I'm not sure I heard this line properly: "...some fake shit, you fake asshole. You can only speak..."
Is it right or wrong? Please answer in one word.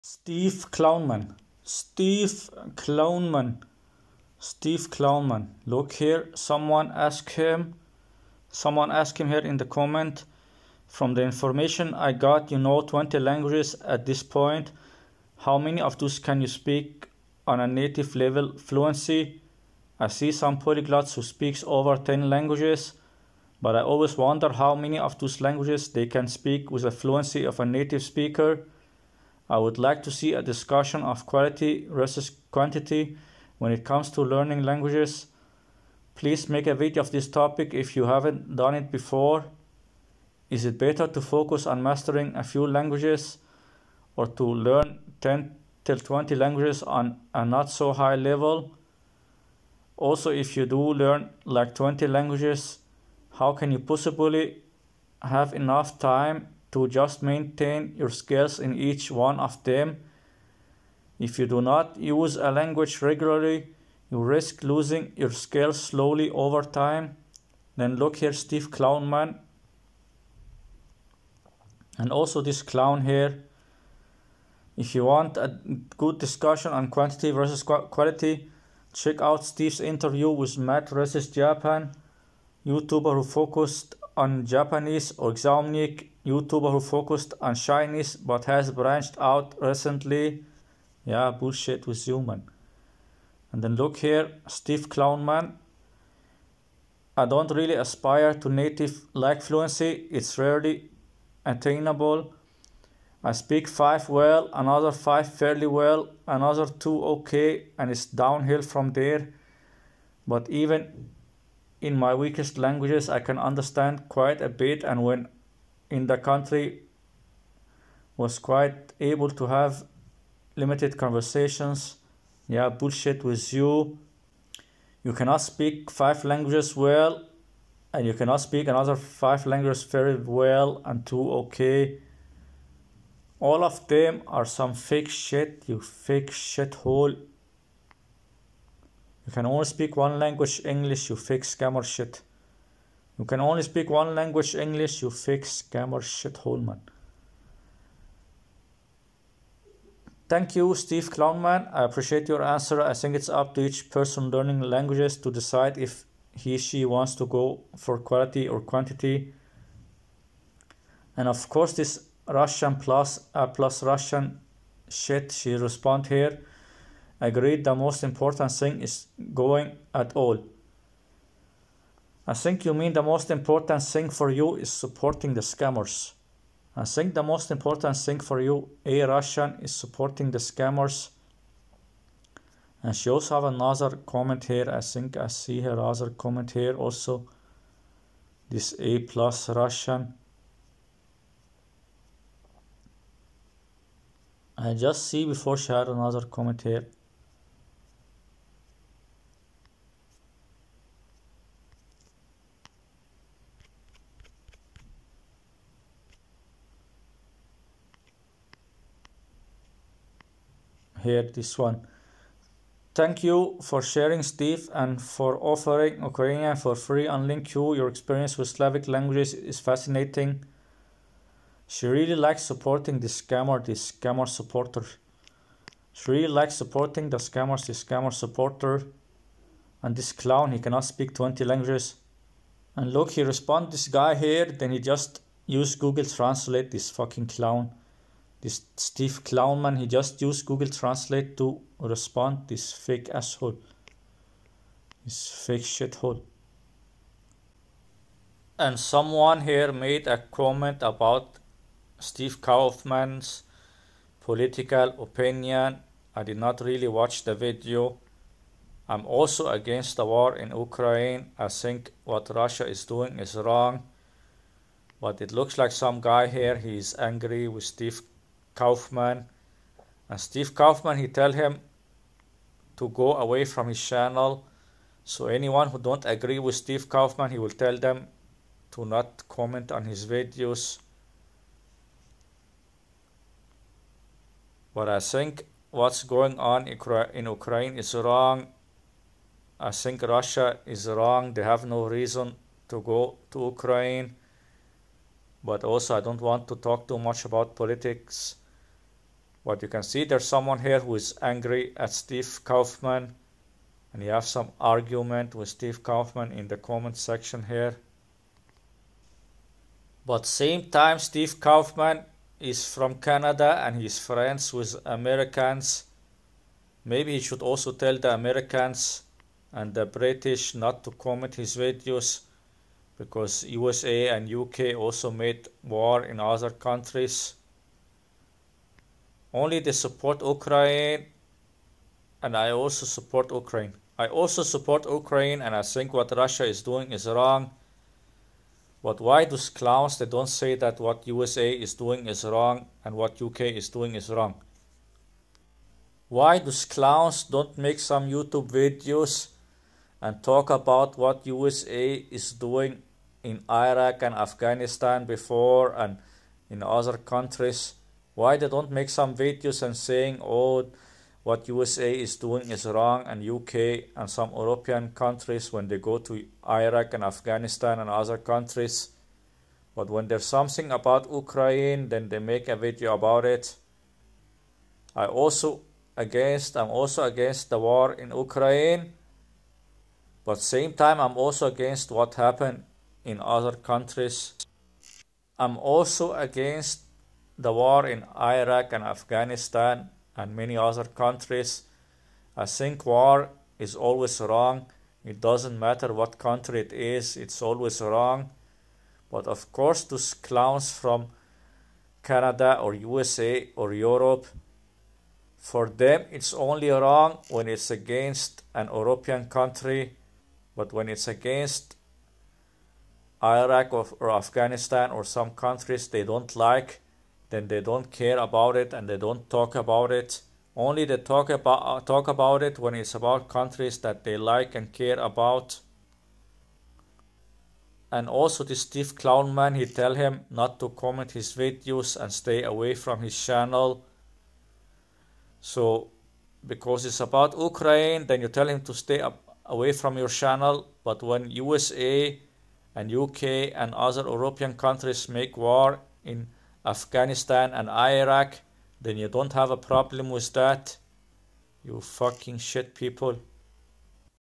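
wrong.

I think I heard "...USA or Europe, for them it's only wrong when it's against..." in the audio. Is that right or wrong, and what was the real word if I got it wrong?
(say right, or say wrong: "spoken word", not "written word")
right.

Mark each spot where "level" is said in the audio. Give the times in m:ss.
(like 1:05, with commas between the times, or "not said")
0:18, 0:48.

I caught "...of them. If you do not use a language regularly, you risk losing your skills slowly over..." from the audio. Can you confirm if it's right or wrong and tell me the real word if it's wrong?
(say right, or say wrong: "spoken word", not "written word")
right.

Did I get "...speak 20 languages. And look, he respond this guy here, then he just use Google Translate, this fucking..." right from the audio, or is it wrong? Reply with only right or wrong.
right.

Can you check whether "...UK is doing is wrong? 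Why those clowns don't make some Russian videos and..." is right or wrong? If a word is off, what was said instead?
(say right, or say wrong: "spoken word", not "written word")
wrong: "YouTube", not "Russian".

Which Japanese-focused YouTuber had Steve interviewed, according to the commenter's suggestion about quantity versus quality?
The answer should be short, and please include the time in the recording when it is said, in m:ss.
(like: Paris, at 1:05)
Matt versus Japan, at 1:20.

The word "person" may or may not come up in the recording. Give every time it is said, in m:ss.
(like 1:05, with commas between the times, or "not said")
2:33.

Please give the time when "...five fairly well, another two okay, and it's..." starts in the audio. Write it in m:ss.
1:44.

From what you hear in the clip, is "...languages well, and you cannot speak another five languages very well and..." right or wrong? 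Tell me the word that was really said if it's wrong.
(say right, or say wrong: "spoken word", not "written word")
right.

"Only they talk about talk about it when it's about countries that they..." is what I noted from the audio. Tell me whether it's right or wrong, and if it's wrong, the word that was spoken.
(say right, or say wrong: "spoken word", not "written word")
right.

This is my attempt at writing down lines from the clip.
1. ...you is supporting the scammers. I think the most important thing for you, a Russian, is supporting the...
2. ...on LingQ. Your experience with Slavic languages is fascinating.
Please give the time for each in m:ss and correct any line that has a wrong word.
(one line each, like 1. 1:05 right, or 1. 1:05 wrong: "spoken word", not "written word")
1. 2:54 right
2. 3:37 right.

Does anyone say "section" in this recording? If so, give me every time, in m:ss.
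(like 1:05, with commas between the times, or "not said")
5:06.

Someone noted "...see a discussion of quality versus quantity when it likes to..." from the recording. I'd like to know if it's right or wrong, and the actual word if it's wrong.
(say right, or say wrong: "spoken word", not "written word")
wrong: "comes", not "likes".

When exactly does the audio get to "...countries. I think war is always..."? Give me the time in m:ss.
6:30.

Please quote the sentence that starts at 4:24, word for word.
But it looks like some guy here, he's angry with Steve Kaufmann.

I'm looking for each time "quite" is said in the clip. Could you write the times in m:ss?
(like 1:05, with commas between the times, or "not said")
1:54, 1:58.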